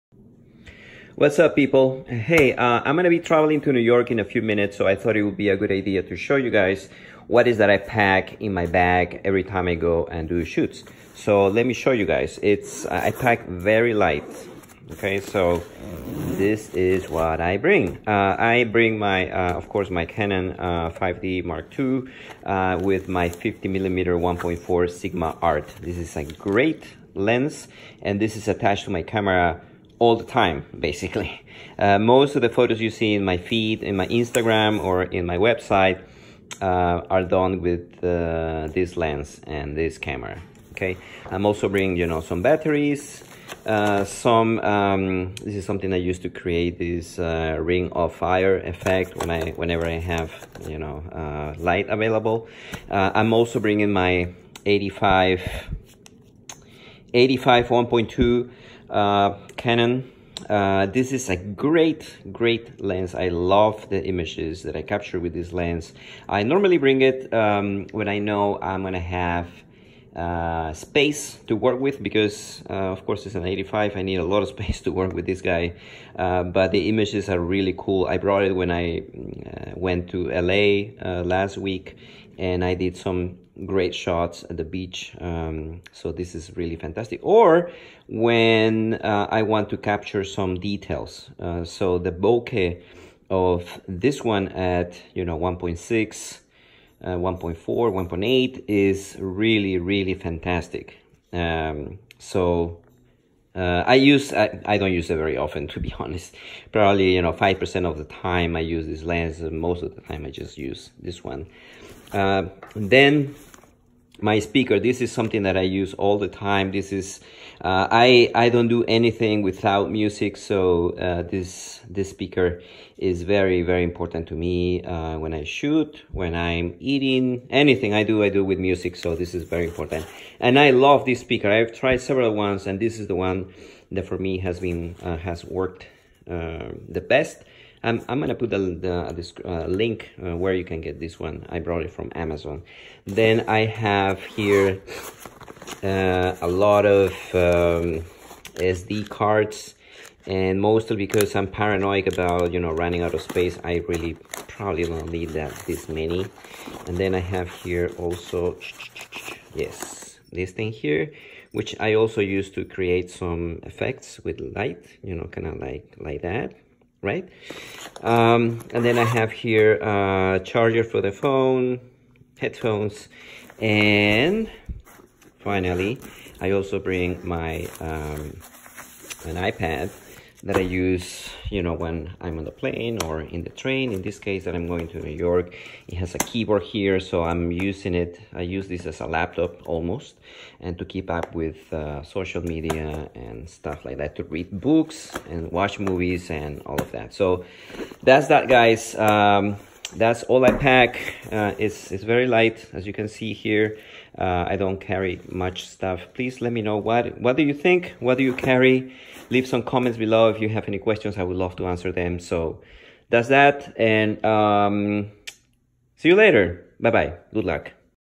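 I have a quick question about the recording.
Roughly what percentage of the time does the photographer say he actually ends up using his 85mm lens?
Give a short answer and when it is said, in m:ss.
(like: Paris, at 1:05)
5%, at 1:47.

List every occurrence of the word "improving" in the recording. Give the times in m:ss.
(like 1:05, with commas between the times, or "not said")
not said.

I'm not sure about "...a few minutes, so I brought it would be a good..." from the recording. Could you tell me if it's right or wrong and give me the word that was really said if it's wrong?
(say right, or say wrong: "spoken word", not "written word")
wrong: "thought", not "brought".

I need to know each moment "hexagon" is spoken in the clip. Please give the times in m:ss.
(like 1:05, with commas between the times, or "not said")
not said.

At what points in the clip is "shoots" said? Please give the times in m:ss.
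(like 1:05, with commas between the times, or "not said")
0:10, 2:05.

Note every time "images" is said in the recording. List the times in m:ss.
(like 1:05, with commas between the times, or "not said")
1:04, 1:16.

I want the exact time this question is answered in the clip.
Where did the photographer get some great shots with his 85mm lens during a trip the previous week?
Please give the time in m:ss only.
1:24.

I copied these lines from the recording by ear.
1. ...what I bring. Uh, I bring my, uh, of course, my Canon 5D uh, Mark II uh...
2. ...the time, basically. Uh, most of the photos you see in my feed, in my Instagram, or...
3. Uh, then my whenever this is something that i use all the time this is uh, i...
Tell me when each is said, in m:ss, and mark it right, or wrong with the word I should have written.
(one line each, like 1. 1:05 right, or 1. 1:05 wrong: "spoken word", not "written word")
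1. 0:17 right
2. 0:30 right
3. 1:52 wrong: "speaker", not "whenever".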